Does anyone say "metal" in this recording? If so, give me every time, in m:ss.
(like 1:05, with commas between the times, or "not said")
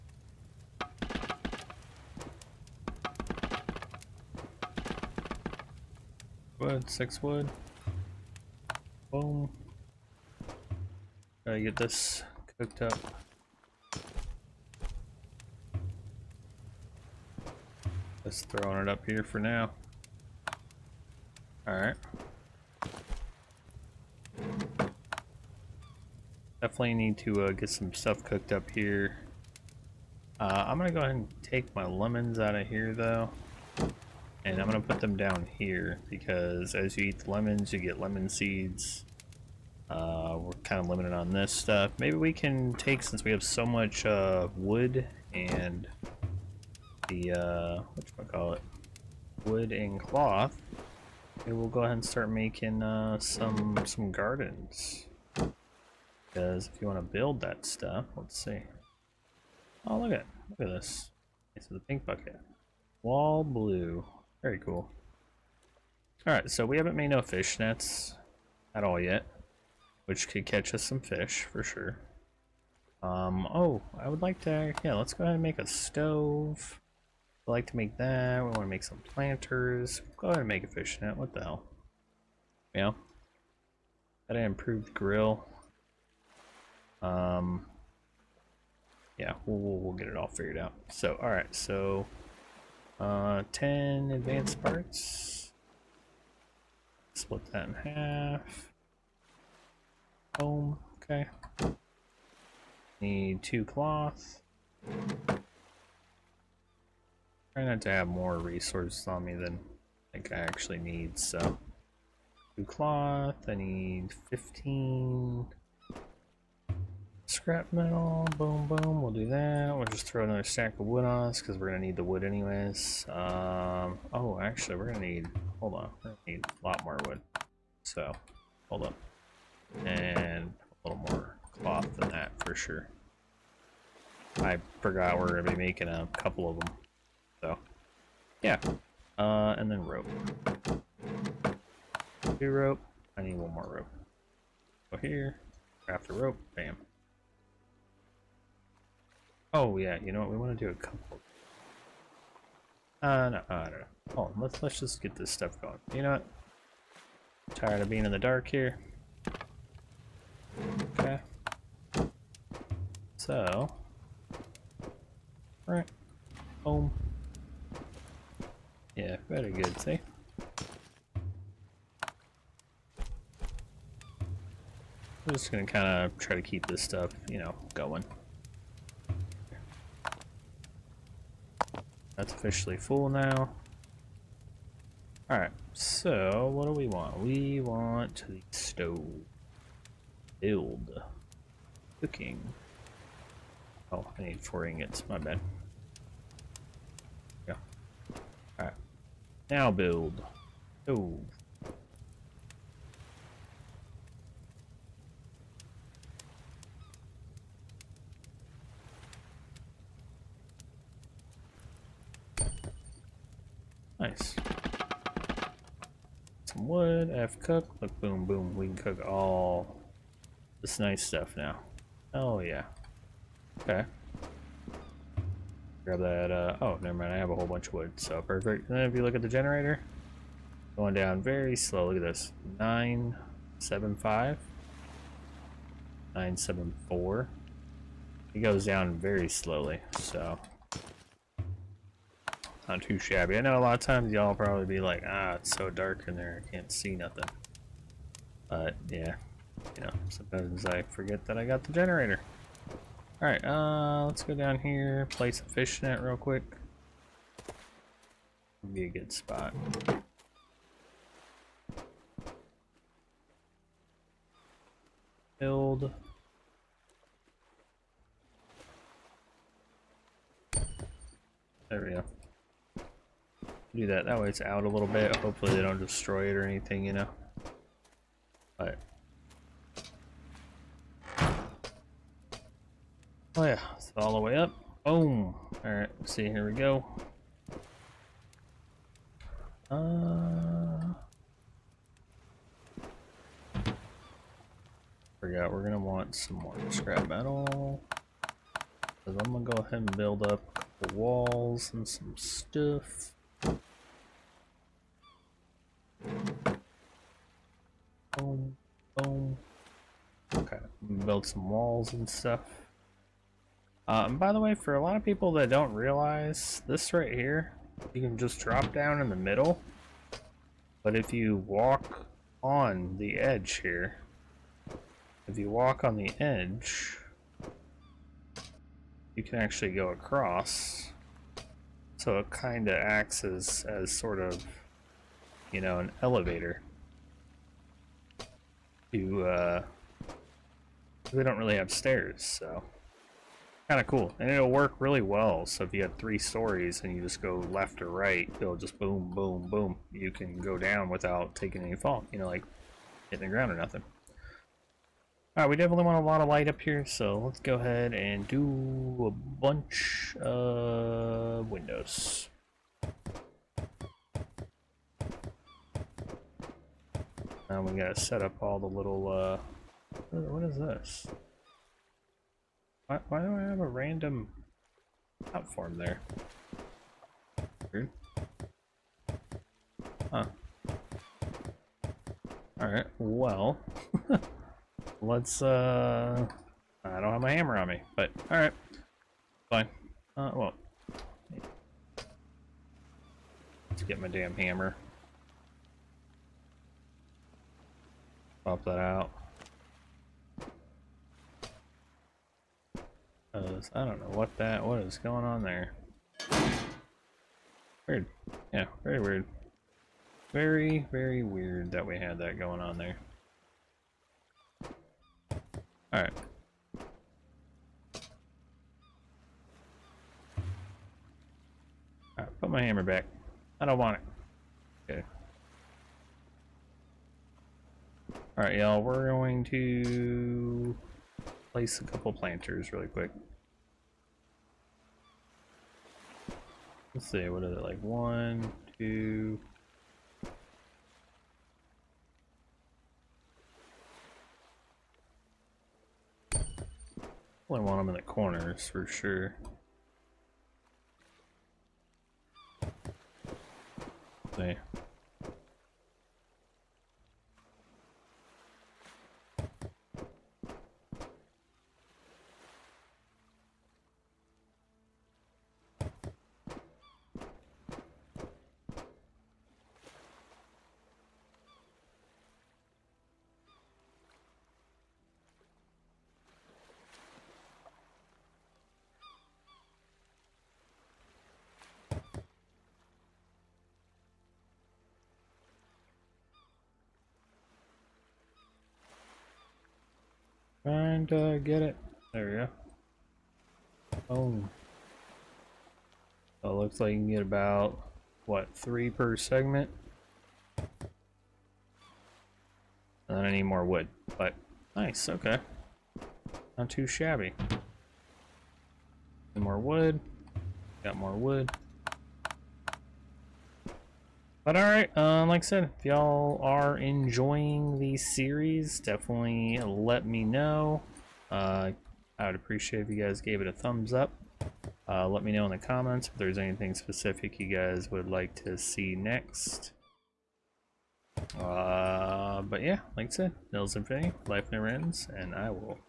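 1:57, 4:57.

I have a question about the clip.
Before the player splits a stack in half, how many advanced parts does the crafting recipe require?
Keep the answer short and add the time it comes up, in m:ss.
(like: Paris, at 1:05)
10, at 1:33.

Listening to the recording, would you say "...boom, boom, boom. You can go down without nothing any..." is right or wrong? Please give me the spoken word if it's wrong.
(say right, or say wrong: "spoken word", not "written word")
wrong: "taking", not "nothing".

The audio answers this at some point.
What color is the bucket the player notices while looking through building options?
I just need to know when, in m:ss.
1:01.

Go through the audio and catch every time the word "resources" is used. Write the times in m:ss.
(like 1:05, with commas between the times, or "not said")
1:48.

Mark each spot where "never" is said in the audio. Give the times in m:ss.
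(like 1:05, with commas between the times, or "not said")
3:46, 8:54.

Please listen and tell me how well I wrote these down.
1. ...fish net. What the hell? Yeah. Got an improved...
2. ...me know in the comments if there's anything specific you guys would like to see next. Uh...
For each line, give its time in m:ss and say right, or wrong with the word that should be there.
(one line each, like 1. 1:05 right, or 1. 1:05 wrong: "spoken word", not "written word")
1. 1:20 right
2. 8:45 right.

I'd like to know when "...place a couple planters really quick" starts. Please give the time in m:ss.
7:11.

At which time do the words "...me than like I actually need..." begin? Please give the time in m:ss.
1:49.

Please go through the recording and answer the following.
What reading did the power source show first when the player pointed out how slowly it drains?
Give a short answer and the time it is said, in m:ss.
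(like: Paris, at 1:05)
975, at 3:52.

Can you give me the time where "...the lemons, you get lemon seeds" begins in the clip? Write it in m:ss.
0:37.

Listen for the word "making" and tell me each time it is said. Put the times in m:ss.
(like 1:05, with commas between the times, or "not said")
0:52, 2:15.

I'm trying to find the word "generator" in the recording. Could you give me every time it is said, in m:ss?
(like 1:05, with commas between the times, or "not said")
3:49, 4:11.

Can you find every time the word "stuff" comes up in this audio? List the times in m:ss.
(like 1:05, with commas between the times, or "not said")
0:27, 0:41, 0:57, 2:35, 2:56, 3:41, 5:02, 5:12.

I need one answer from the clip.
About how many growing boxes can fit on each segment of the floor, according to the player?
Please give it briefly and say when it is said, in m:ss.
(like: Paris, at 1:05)
3, at 8:18.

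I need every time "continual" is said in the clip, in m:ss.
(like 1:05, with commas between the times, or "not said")
not said.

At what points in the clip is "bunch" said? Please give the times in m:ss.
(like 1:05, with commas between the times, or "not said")
3:47, 5:59.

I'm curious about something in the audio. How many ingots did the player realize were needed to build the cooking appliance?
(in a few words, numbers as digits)
4.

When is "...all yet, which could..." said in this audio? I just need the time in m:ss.
1:08.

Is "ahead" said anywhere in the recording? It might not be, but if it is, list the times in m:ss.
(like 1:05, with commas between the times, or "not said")
0:30, 0:51, 1:15, 1:20, 4:59, 5:57.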